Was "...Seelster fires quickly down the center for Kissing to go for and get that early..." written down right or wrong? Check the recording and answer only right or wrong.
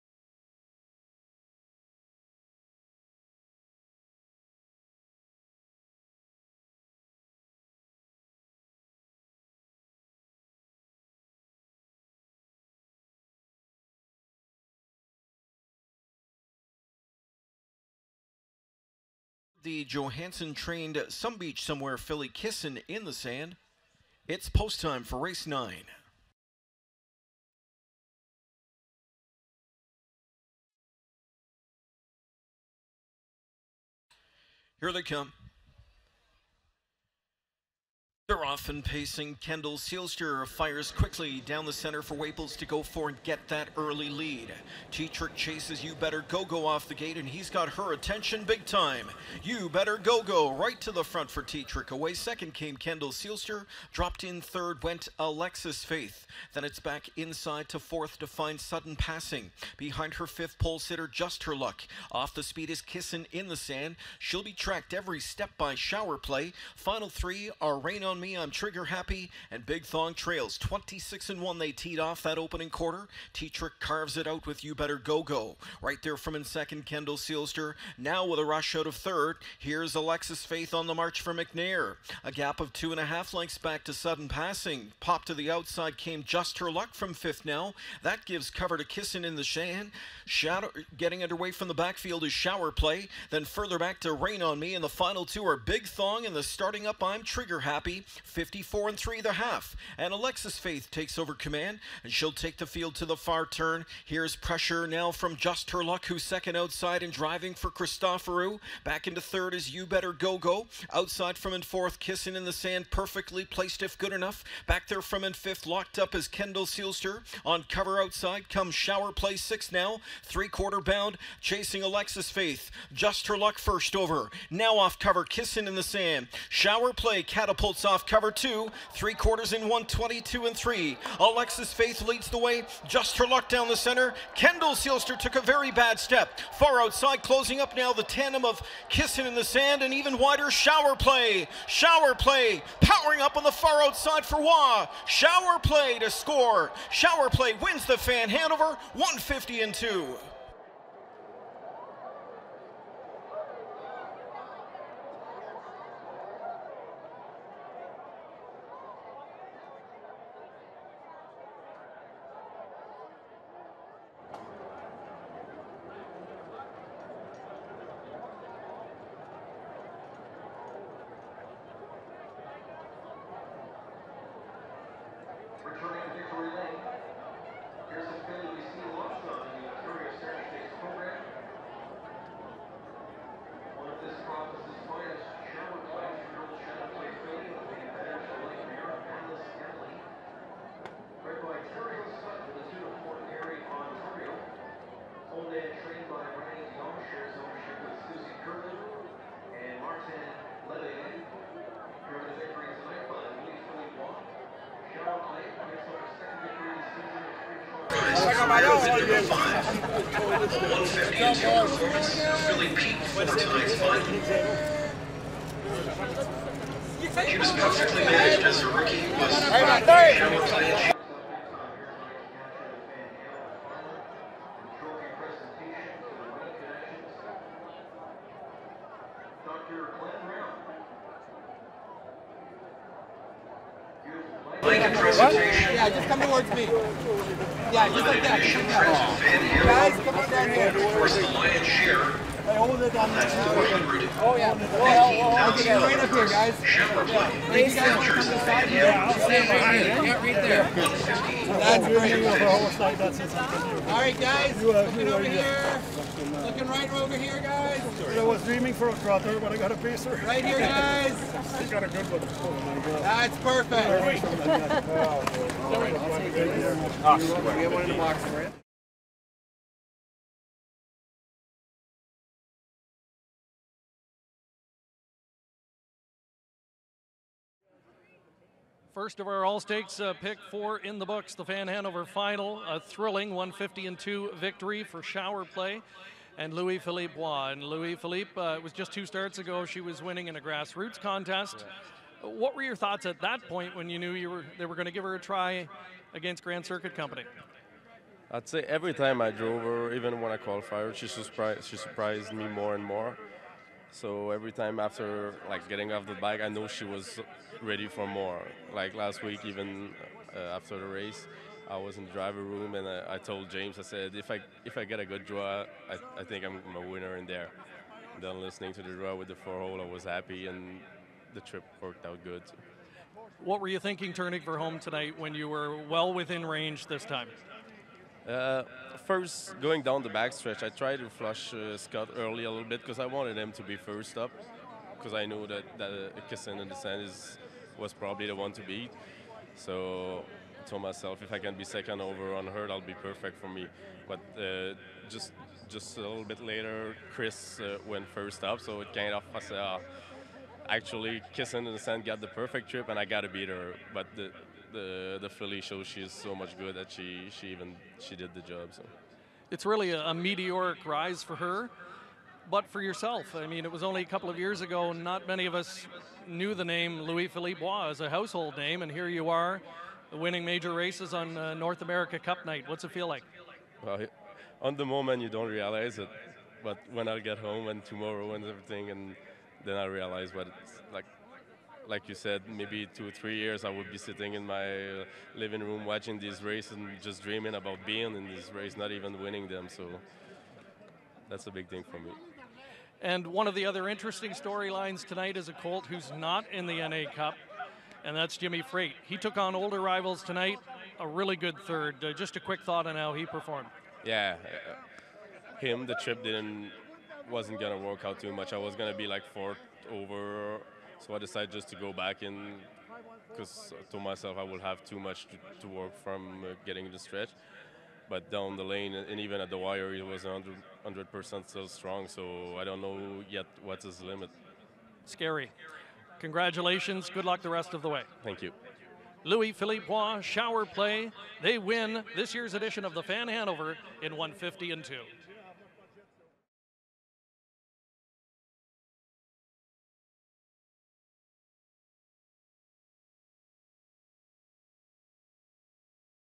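wrong.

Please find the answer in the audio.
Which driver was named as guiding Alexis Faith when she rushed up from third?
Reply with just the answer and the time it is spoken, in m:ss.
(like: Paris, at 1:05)
McNair, at 1:21.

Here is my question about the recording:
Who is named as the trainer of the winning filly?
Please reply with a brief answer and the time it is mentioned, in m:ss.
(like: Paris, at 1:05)
Ryan Gomsher, at 3:16.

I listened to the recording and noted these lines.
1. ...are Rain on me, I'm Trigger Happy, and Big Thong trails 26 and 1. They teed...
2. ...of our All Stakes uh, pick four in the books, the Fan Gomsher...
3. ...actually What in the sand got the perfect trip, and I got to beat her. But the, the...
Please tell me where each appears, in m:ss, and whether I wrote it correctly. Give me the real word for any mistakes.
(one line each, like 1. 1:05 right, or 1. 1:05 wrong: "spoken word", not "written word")
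1. 1:07 right
2. 4:39 wrong: "Hanover", not "Gomsher"
3. 5:50 wrong: "Kissin", not "What".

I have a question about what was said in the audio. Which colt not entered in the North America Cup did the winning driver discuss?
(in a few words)
Jimmy Freight.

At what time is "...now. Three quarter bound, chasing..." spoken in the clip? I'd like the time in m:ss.
1:59.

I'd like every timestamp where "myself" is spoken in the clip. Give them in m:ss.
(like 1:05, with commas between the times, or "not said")
5:40, 6:54.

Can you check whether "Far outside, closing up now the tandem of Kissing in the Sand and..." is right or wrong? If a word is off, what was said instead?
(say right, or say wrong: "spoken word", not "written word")
right.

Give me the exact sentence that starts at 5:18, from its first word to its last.
And then listening to the draw with the four hole, I was happy and the trip worked out good.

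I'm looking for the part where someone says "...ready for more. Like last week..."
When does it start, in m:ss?
5:07.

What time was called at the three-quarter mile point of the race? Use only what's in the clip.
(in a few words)
122 and 3.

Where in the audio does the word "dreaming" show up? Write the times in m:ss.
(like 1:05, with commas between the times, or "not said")
4:18, 6:27.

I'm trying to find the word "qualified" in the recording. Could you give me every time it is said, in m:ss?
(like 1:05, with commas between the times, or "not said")
5:00.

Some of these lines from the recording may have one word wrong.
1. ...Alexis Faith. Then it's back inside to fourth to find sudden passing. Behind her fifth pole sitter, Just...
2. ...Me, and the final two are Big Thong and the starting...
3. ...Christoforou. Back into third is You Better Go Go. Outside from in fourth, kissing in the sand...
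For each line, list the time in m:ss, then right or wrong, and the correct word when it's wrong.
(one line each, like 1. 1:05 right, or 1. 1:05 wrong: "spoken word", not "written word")
1. 0:55 right
2. 1:34 right
3. 1:47 right.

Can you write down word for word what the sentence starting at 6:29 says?
So that's a big thing for me.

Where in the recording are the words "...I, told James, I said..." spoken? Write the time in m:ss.
5:13.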